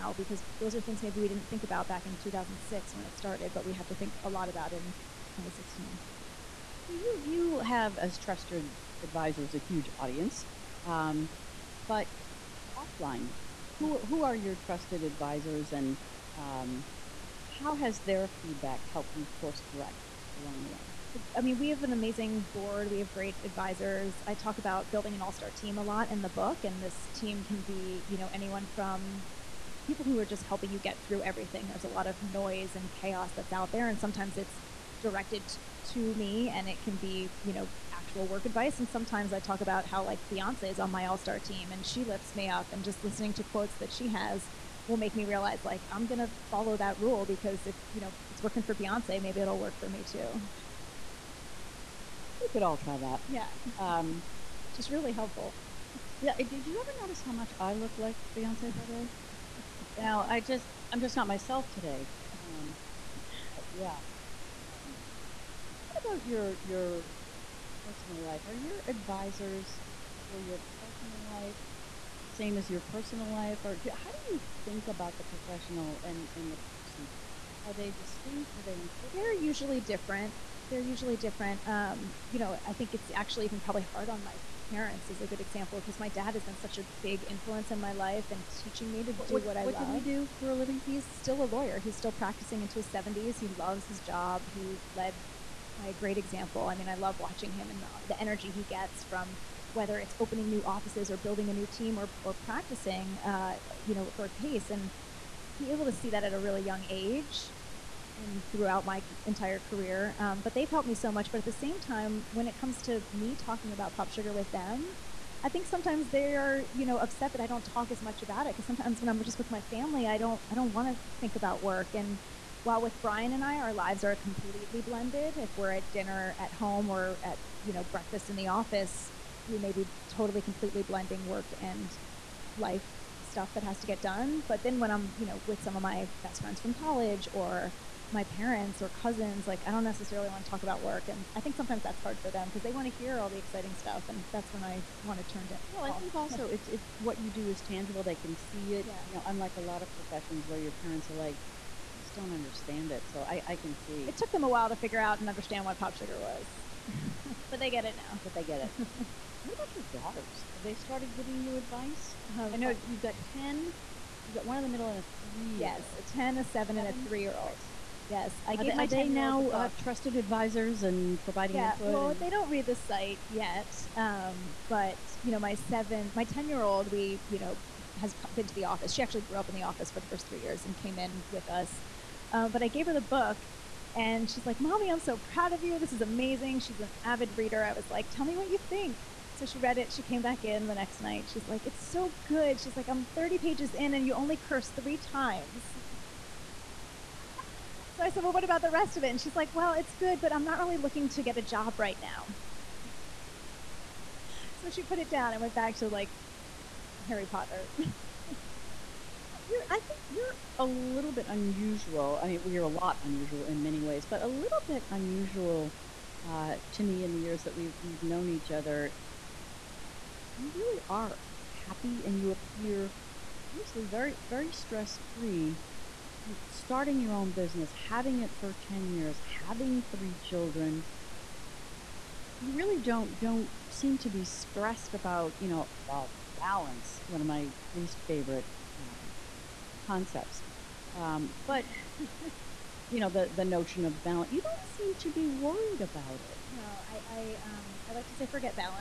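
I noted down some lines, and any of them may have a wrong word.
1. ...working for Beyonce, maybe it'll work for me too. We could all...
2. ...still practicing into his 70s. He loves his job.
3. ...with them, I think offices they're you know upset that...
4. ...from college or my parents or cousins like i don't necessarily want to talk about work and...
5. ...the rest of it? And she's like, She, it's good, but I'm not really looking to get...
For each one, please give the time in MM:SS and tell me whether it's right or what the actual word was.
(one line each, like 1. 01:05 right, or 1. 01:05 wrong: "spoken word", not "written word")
1. 00:48 right
2. 01:31 right
3. 01:54 wrong: "sometimes", not "offices"
4. 02:16 right
5. 03:18 wrong: "Well", not "She".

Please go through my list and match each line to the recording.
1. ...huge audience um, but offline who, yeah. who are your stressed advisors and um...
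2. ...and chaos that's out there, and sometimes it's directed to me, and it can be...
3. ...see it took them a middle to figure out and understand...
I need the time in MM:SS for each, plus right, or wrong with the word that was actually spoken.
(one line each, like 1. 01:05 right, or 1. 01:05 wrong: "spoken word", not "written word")
1. 00:09 wrong: "trusted", not "stressed"
2. 00:32 right
3. 02:33 wrong: "while", not "middle".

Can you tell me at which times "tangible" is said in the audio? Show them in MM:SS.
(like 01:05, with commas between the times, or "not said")
02:27.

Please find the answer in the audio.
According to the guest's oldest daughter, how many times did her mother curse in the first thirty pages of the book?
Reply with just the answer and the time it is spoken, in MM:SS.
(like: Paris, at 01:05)
3, at 03:14.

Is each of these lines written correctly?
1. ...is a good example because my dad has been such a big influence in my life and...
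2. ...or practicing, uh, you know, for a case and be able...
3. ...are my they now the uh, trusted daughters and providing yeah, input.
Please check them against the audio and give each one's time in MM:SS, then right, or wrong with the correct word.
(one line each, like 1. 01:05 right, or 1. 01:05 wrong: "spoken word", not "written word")
1. 01:25 right
2. 01:42 right
3. 02:48 wrong: "advisors", not "daughters".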